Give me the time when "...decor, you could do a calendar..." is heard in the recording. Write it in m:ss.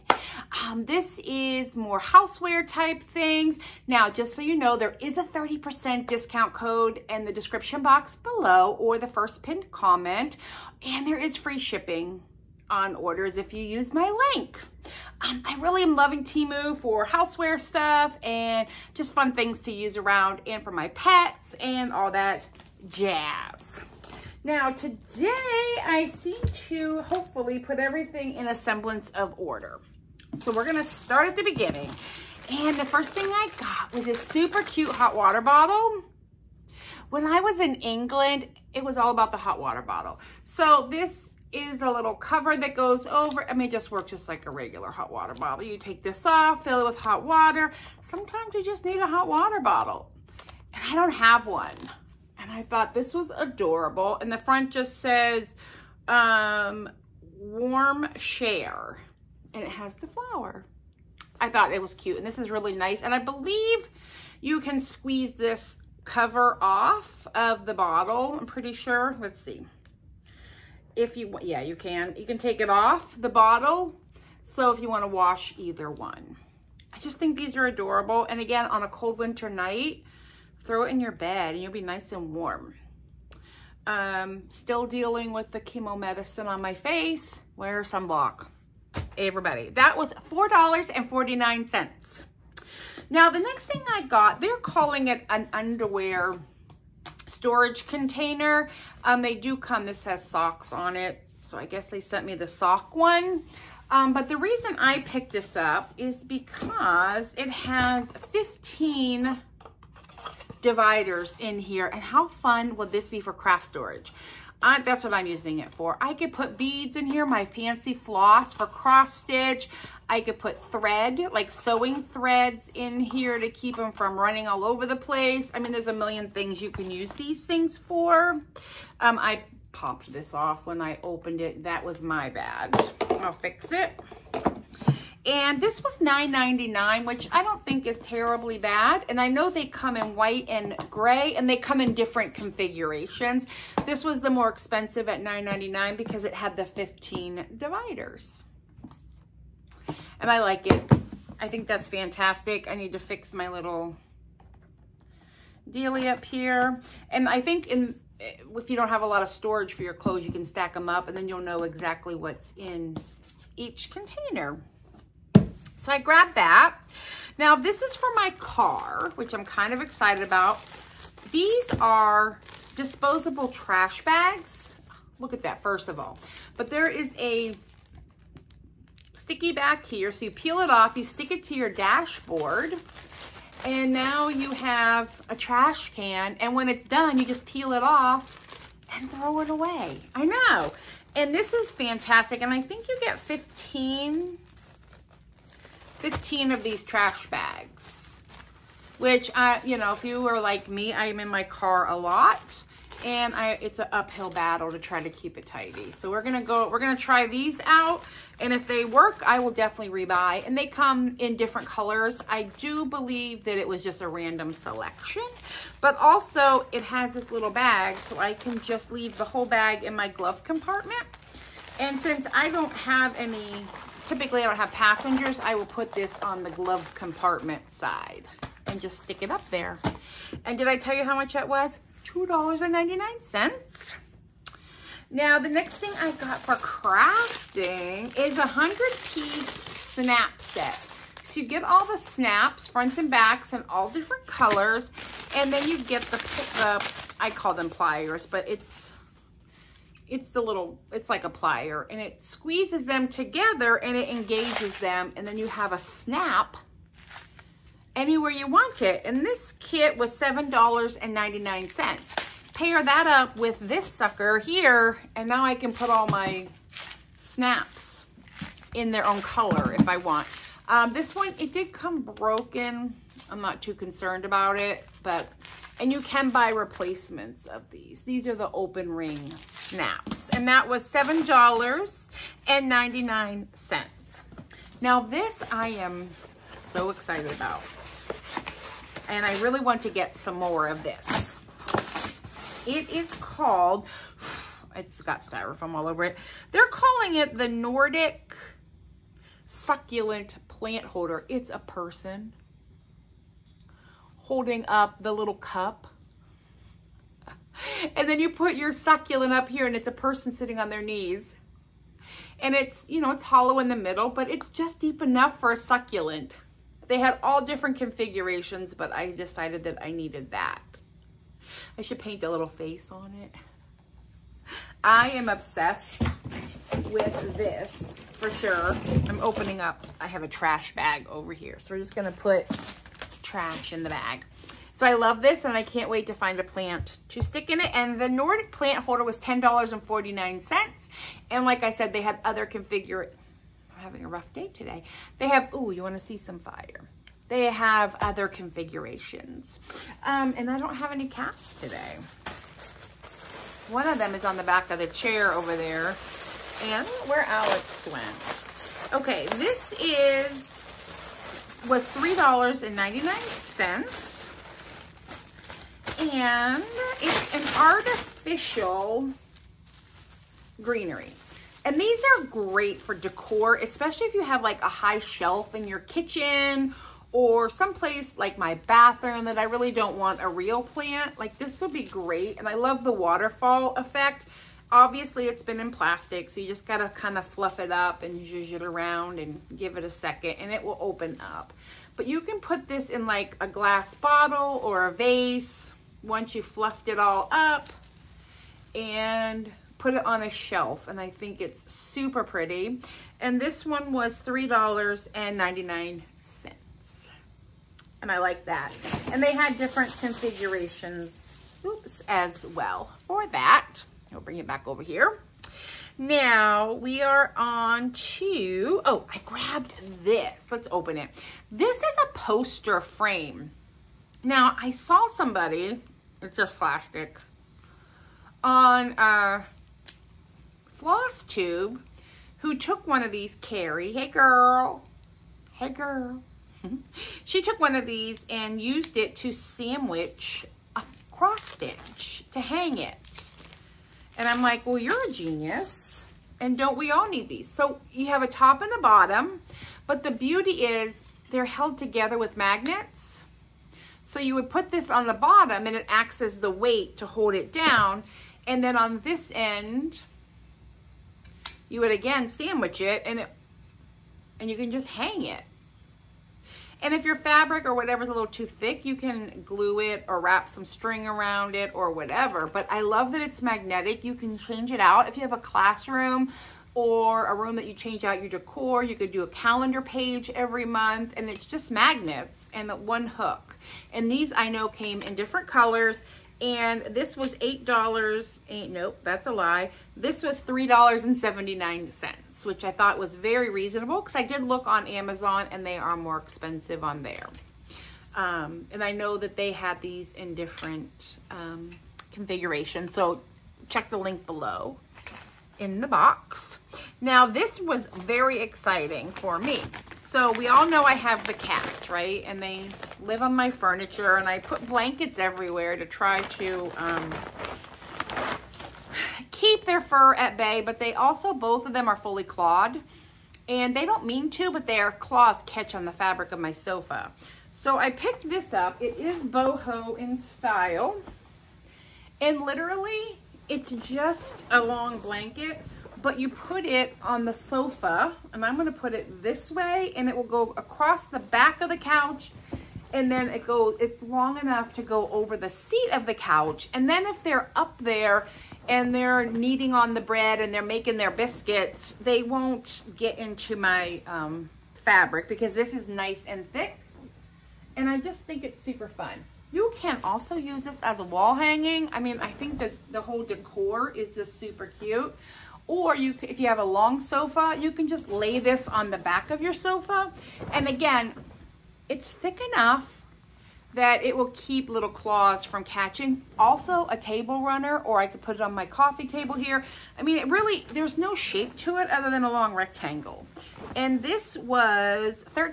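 7:58.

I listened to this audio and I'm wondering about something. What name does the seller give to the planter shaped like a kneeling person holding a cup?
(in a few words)
Nordic succulent plant holder.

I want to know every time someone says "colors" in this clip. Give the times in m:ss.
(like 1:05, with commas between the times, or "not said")
3:31, 4:04, 4:29, 8:05.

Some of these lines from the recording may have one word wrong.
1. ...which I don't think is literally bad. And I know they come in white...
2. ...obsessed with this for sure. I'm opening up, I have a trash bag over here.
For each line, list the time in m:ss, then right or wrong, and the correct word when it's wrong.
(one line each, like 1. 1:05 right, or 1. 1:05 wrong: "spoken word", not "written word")
1. 2:17 wrong: "terribly", not "literally"
2. 5:25 right.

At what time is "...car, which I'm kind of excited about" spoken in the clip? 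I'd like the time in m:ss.
2:48.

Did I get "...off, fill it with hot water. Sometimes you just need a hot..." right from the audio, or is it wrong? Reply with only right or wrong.
right.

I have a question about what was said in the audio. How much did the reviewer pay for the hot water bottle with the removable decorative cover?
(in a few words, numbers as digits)
$4.49.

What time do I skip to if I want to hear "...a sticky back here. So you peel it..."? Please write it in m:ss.
2:57.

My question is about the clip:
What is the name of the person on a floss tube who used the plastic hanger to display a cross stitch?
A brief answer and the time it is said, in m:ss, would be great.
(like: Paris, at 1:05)
Carrie, at 7:13.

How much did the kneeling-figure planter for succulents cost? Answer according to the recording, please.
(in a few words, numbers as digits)
$10.49.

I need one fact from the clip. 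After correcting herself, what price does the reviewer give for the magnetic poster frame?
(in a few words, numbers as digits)
$3.79.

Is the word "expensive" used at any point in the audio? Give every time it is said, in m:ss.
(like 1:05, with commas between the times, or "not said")
2:24, 8:16.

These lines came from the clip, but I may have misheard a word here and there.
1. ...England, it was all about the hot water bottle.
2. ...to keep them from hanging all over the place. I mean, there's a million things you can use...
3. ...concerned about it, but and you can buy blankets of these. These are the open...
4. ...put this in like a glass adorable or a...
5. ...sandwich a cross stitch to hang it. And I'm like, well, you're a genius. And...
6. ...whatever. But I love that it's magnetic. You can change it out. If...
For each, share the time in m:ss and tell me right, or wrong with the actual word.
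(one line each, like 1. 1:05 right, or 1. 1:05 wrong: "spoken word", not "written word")
1. 0:37 right
2. 2:03 wrong: "running", not "hanging"
3. 4:33 wrong: "replacements", not "blankets"
4. 6:32 wrong: "bottle", not "adorable"
5. 7:19 right
6. 7:51 right.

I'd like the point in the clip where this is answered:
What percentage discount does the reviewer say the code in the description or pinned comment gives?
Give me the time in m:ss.
0:05.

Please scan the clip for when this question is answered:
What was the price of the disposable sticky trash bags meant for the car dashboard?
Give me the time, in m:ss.
3:52.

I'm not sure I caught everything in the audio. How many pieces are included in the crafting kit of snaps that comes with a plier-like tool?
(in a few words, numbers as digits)
100.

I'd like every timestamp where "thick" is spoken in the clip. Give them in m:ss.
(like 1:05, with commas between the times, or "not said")
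7:48, 9:16, 9:32.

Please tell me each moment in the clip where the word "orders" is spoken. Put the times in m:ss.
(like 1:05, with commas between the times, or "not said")
0:12, 0:29.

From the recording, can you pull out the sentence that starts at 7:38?
And then on this end, you would again sandwich it and it, and you can just hang it.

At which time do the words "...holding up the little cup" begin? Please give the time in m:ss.
5:04.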